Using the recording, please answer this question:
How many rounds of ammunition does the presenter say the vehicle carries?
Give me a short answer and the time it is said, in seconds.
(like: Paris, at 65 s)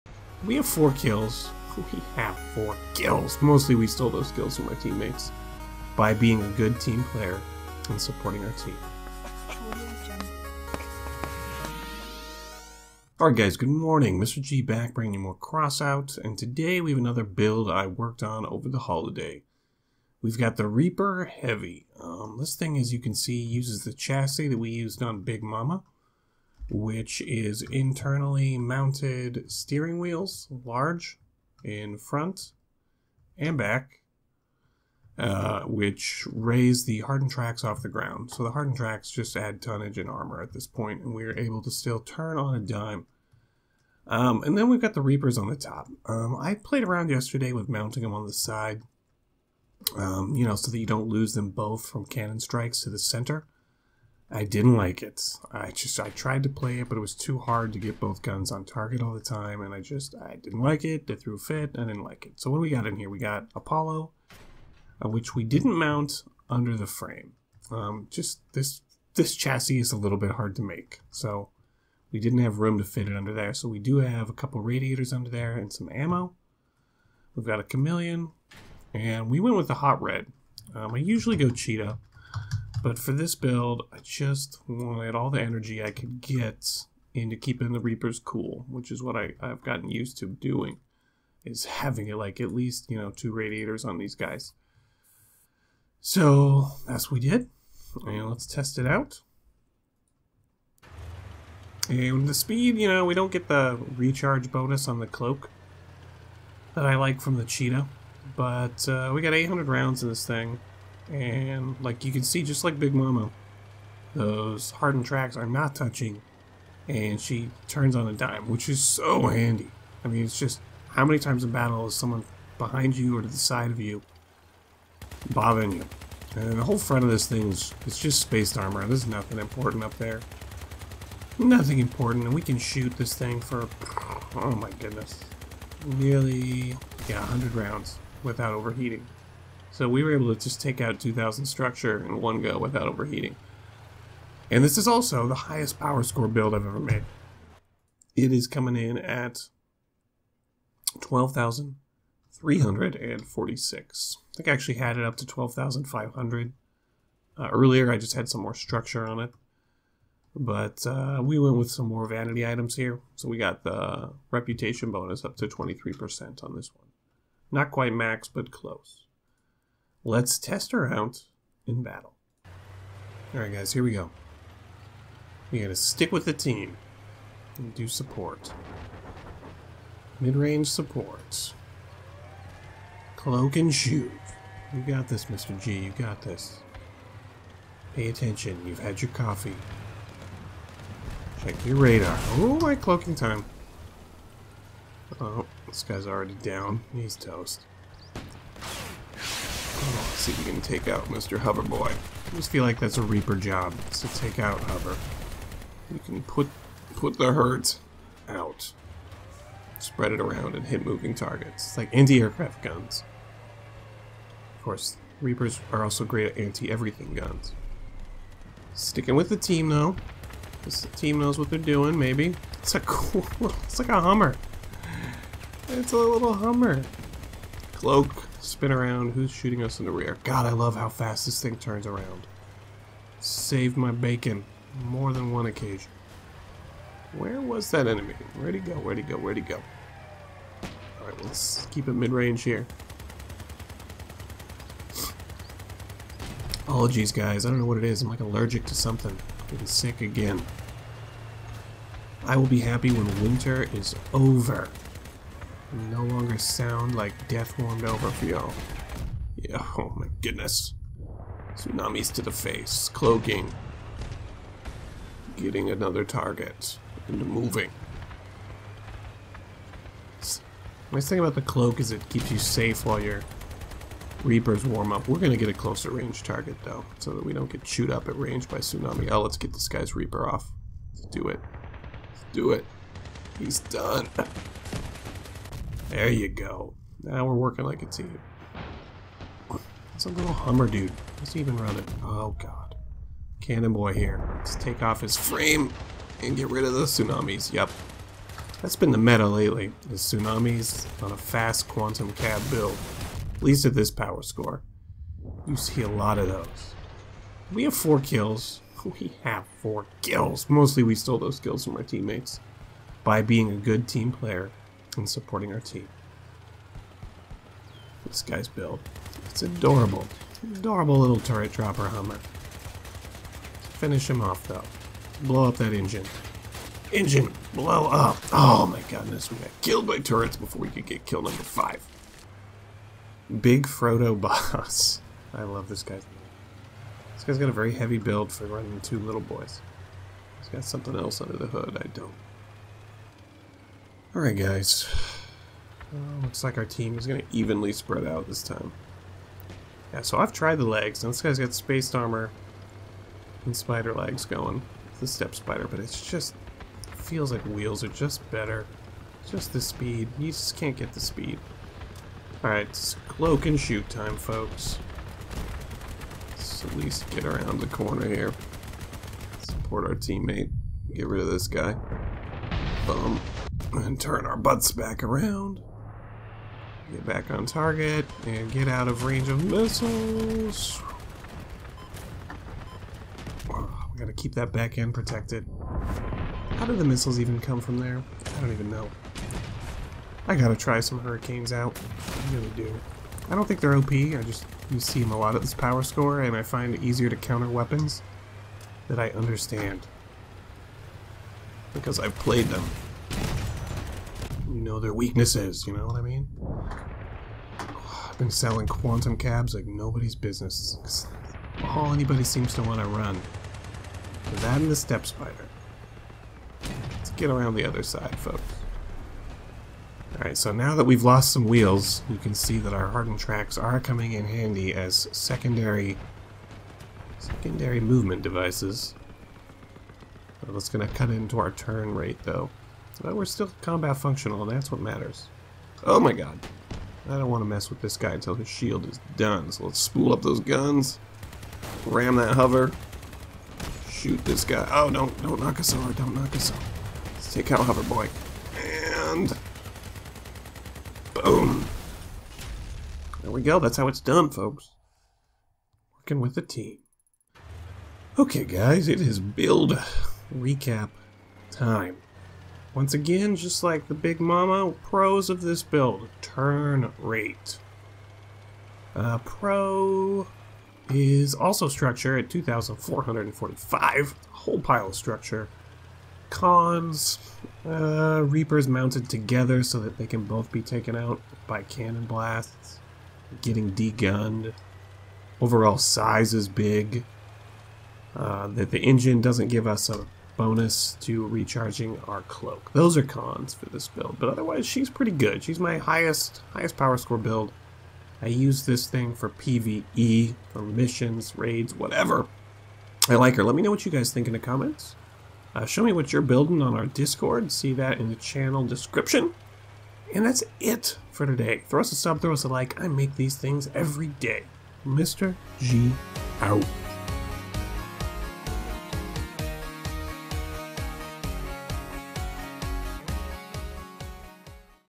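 800, at 109 s.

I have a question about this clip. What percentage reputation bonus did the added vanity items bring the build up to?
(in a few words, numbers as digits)
23%.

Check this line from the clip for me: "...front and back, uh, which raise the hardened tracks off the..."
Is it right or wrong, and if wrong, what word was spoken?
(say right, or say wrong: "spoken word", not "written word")
right.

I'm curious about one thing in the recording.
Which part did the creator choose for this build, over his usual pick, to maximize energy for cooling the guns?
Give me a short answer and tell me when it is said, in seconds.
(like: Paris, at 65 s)
hot red, at 79 s.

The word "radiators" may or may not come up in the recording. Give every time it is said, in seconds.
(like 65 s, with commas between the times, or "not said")
74 s, 93 s.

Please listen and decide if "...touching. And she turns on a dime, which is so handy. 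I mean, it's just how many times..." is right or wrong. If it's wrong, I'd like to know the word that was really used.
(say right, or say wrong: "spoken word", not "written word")
right.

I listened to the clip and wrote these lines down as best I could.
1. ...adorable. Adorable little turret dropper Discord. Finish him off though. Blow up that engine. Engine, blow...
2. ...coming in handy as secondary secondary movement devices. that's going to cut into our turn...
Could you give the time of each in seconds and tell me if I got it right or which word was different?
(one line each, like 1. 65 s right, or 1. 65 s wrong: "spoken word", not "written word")
1. 319 s wrong: "Hummer", not "Discord"
2. 423 s right.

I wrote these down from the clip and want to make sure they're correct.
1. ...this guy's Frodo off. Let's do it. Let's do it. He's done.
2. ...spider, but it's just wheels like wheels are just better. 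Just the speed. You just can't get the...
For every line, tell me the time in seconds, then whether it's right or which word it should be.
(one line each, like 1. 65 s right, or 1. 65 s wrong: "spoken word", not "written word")
1. 279 s wrong: "Reaper", not "Frodo"
2. 355 s wrong: "feels", not "wheels".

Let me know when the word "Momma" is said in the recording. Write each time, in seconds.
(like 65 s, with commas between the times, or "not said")
25 s, 112 s, 464 s.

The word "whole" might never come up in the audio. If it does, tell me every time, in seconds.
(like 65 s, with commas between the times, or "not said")
126 s, 474 s.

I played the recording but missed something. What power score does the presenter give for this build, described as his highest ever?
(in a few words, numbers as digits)
12,346.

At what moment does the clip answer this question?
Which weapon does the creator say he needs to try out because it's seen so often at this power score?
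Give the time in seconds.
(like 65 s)
390 s.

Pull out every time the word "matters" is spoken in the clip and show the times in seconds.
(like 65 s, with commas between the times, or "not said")
434 s.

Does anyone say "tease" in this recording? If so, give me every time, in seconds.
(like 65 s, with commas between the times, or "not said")
not said.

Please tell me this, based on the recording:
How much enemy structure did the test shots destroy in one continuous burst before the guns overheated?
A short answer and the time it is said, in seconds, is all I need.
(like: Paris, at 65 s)
2000, at 140 s.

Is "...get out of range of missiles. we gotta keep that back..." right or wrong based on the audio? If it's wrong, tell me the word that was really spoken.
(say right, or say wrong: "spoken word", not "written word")
right.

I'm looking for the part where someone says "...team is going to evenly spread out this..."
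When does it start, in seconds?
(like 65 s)
346 s.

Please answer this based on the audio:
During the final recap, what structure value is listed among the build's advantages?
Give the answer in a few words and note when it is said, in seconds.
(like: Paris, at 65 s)
2,445, at 472 s.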